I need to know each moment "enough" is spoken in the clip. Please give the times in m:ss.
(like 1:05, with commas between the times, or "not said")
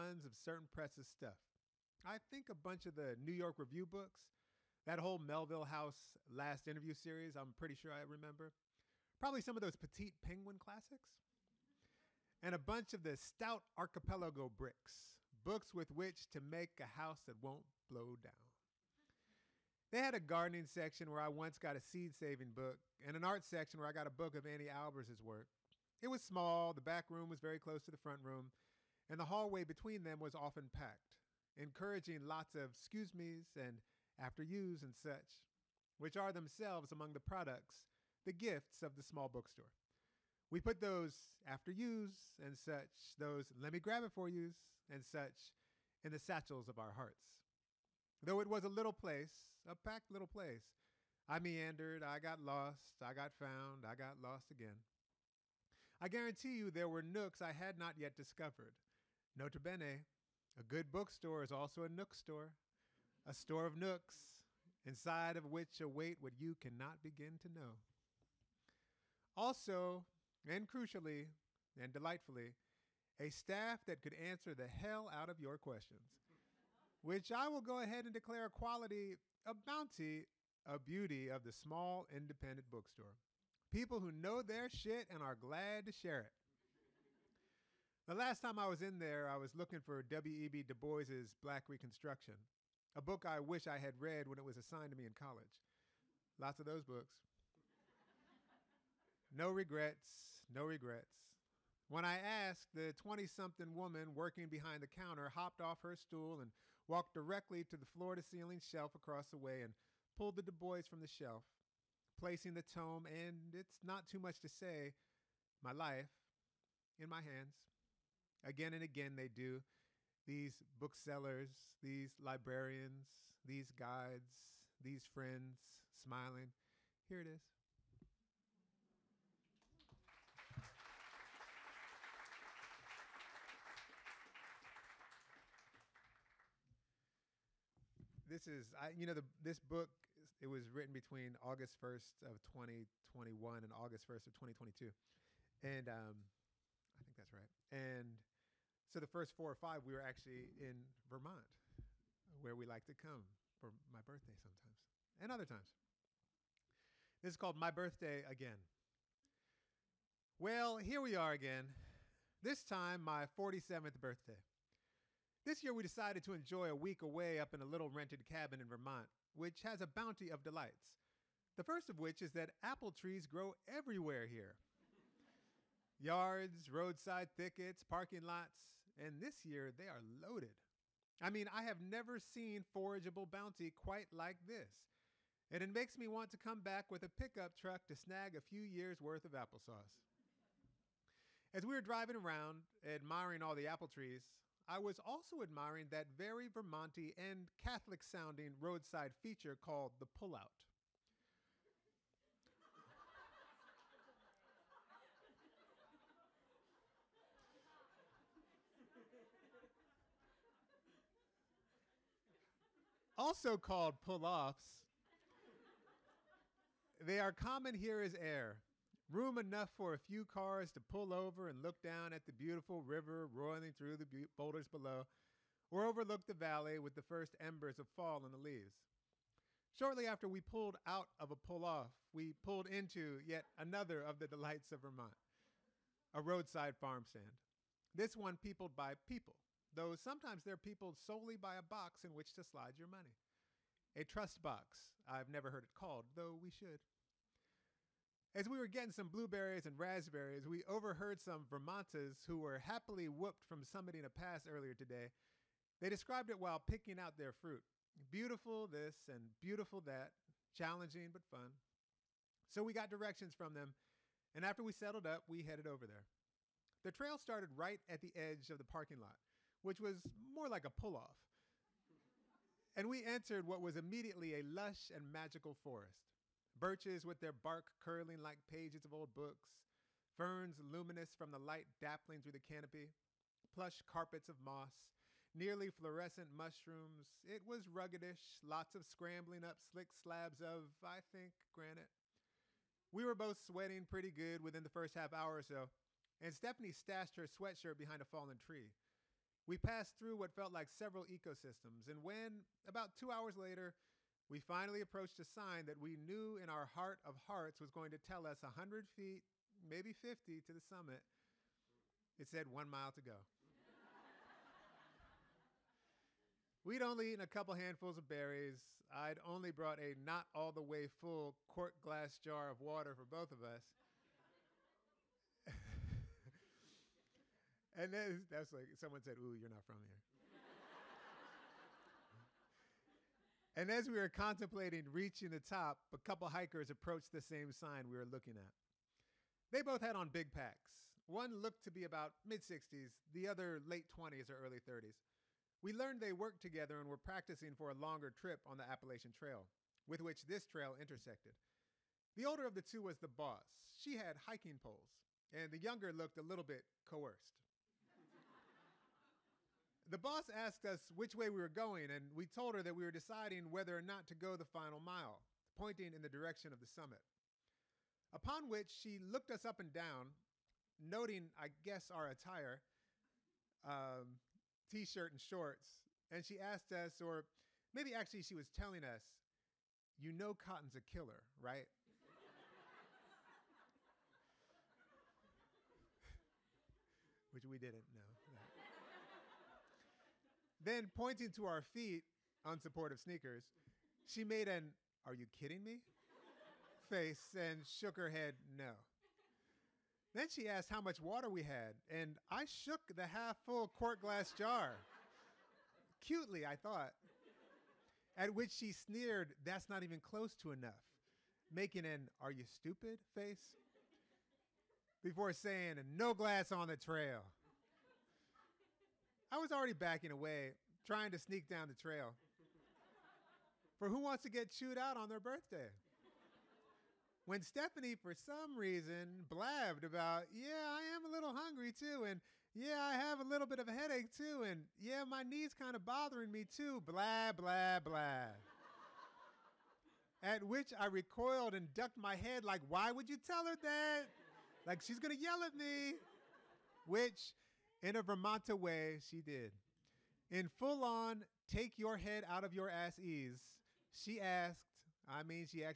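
3:39, 6:50.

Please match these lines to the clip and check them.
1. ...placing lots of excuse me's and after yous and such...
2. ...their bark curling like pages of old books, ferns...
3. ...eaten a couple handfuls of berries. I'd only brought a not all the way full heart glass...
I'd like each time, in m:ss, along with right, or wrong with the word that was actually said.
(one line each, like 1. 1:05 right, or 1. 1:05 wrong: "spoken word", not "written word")
1. 0:31 wrong: "encouraging", not "placing"
2. 4:37 right
3. 5:17 wrong: "quart", not "heart".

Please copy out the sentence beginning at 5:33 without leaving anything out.
And as we were contemplating reaching the top, a couple hikers approached the same sign we were looking at.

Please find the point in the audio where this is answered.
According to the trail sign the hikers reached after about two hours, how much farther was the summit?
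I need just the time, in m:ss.
5:12.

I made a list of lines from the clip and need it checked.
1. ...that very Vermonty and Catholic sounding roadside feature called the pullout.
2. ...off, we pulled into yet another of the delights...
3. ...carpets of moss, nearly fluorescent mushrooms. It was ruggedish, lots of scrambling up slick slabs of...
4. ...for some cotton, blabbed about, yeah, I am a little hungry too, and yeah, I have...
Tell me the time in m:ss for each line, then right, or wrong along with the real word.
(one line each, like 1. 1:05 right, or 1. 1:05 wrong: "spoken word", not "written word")
1. 3:15 right
2. 3:51 right
3. 4:43 right
4. 7:07 wrong: "reason", not "cotton".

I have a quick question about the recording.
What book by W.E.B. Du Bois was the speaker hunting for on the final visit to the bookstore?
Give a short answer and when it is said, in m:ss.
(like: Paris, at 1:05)
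Black Reconstruction, at 1:31.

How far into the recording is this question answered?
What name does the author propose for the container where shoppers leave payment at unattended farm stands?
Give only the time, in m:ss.
4:03.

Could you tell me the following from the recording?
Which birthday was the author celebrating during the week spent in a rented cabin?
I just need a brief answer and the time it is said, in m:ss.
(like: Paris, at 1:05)
47th, at 2:43.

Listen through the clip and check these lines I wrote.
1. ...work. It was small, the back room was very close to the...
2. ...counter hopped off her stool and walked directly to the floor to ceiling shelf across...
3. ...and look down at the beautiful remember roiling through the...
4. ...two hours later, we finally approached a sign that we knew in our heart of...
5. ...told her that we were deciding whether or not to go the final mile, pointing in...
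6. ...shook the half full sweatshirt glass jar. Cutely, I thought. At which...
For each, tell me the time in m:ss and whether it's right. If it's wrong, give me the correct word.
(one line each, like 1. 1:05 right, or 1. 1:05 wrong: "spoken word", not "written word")
1. 0:25 right
2. 1:44 right
3. 3:41 wrong: "river", not "remember"
4. 5:02 right
5. 6:02 right
6. 6:42 wrong: "quart", not "sweatshirt".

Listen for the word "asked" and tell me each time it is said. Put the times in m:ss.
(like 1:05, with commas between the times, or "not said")
1:42, 6:00, 6:16, 6:40, 7:34.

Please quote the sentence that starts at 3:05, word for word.
And it makes me want to come back with a pickup truck to snag a few years' worth of applesauce.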